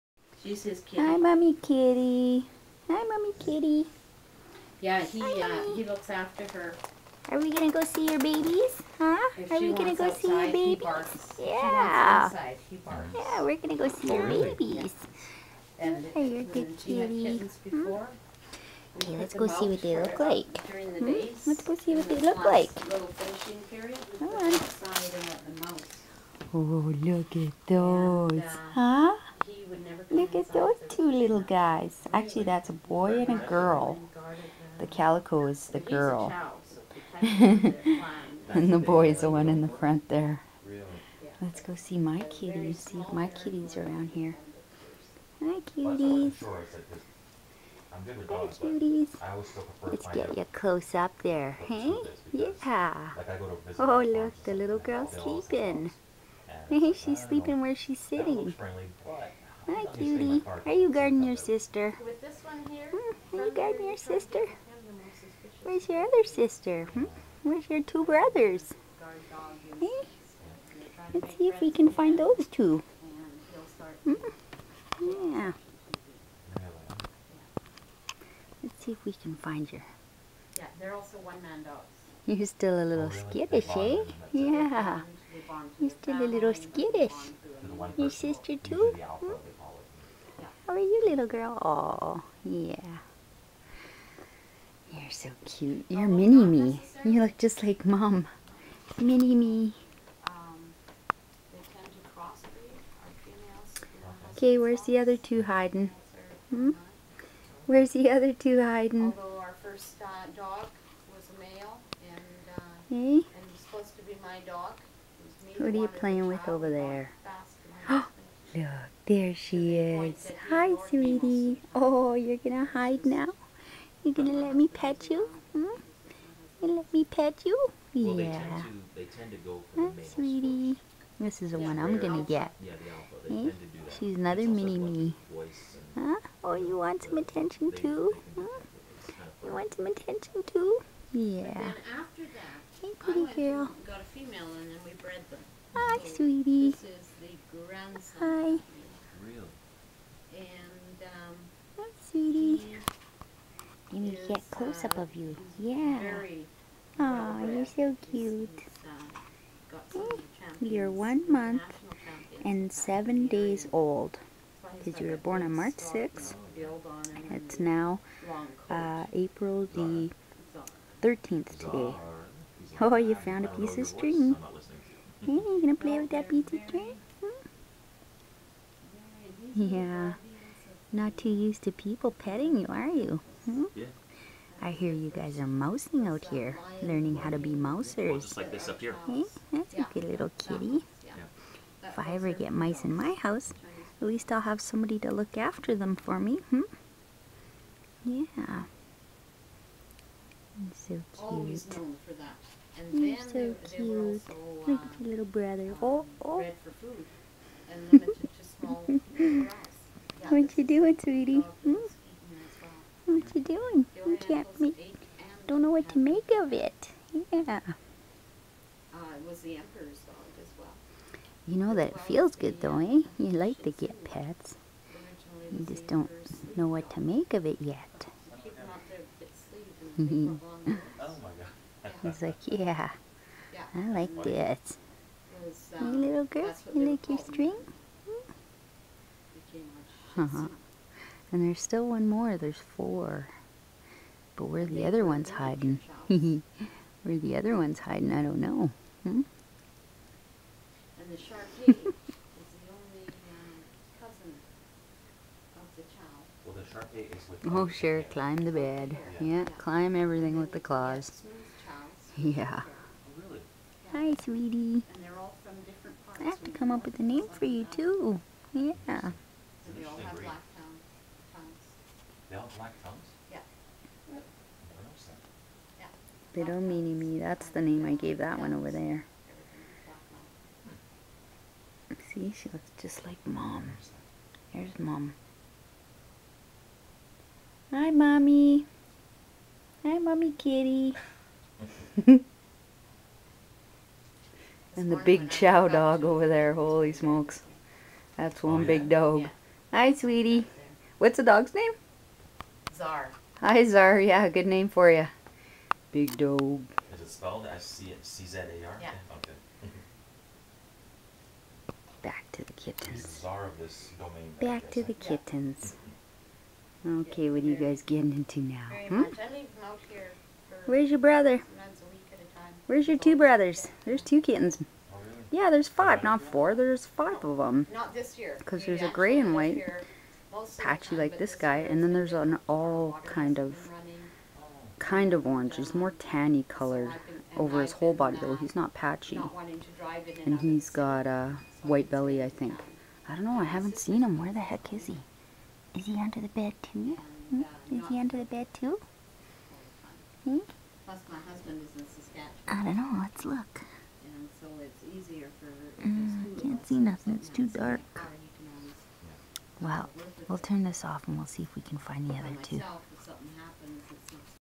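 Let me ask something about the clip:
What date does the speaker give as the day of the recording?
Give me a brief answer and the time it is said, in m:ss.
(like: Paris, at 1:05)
April 13, at 2:49.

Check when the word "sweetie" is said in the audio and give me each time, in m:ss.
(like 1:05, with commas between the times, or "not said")
2:00, 2:10, 2:26, 2:32, 3:30, 4:24, 4:59.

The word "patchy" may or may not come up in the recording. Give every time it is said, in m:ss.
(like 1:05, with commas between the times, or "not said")
5:30, 5:38.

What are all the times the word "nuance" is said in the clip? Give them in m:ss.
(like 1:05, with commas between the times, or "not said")
not said.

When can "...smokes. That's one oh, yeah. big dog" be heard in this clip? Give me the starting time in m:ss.
4:56.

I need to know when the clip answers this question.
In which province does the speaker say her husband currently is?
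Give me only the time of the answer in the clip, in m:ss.
5:51.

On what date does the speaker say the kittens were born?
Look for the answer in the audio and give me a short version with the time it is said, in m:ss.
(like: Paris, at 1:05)
March 6th, at 2:45.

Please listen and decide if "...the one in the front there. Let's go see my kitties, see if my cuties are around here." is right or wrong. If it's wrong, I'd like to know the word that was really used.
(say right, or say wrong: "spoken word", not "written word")
wrong: "kitties", not "cuties".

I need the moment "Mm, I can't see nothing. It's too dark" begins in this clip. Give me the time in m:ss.
5:55.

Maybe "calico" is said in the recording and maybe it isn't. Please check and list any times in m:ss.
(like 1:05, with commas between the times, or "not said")
0:34.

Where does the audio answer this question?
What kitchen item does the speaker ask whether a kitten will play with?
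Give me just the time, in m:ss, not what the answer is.
2:56.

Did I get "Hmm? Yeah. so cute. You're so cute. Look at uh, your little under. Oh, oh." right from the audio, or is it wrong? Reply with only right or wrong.
wrong.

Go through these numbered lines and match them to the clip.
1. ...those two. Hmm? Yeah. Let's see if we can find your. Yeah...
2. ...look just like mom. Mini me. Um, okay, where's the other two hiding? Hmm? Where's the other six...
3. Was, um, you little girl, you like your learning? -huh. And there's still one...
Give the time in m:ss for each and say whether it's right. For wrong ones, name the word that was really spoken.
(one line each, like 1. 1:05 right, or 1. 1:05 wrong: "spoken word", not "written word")
1. 1:12 right
2. 1:37 wrong: "two", not "six"
3. 3:55 wrong: "string", not "learning".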